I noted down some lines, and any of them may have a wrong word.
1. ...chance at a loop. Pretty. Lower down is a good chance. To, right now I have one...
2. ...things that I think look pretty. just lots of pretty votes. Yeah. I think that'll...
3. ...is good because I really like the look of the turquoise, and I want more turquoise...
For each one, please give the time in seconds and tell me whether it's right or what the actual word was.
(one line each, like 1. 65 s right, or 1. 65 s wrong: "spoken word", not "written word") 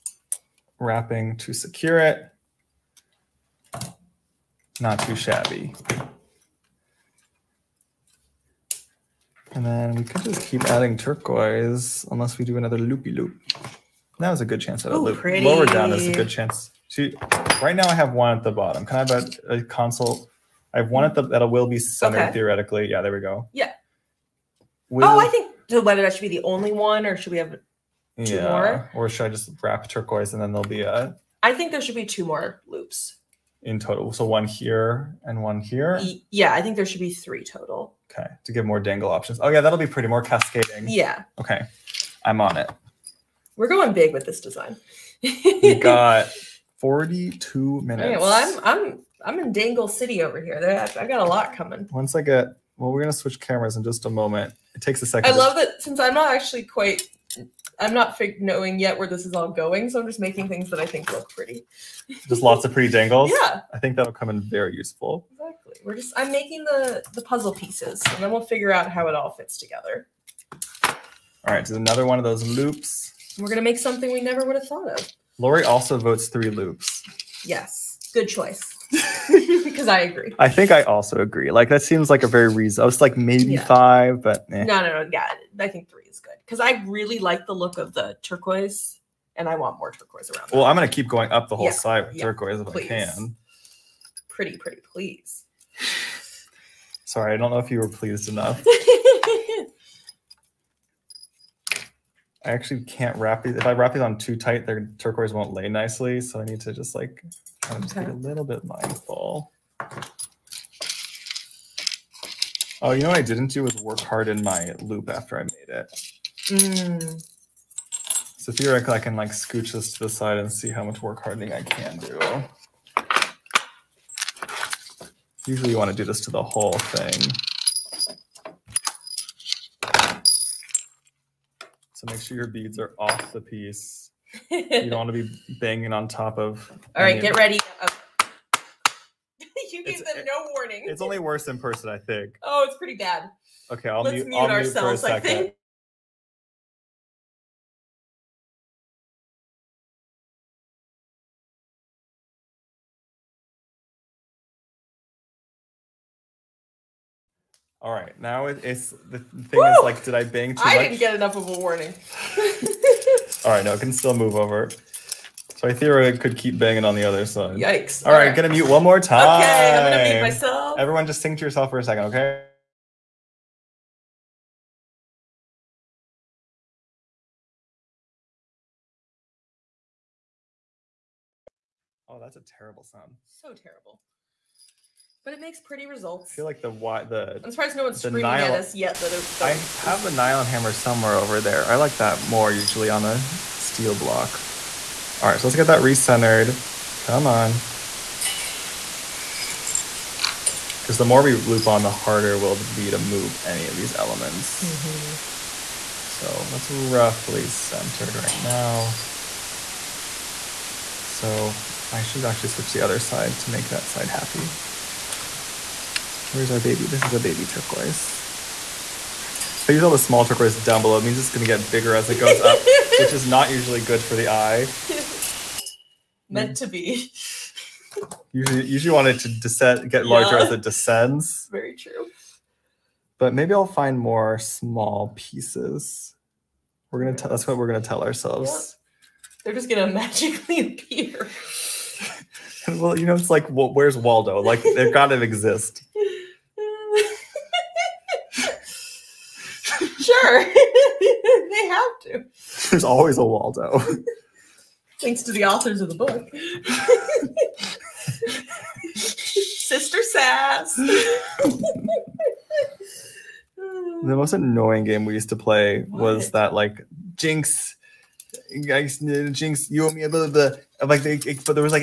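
1. 14 s right
2. 60 s wrong: "dangles", not "votes"
3. 86 s right.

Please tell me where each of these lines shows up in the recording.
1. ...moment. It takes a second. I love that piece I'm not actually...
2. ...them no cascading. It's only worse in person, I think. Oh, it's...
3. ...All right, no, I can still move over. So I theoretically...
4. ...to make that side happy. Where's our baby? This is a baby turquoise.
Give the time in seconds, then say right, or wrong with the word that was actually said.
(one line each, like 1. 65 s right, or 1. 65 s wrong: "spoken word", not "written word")
1. 54 s wrong: "since", not "piece"
2. 140 s wrong: "warning", not "cascading"
3. 163 s right
4. 213 s right.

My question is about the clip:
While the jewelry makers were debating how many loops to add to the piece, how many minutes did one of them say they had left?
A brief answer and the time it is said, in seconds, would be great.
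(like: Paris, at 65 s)
42, at 46 s.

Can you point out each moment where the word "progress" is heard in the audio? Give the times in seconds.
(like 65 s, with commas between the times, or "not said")
not said.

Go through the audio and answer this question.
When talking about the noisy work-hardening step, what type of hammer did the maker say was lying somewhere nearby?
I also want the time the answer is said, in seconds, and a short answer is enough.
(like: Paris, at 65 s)
nylon hammer, at 190 s.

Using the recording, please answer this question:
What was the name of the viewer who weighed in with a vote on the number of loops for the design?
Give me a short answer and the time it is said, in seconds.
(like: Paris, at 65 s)
Lori, at 75 s.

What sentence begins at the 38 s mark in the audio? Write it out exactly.
Okay, to give more dangle options.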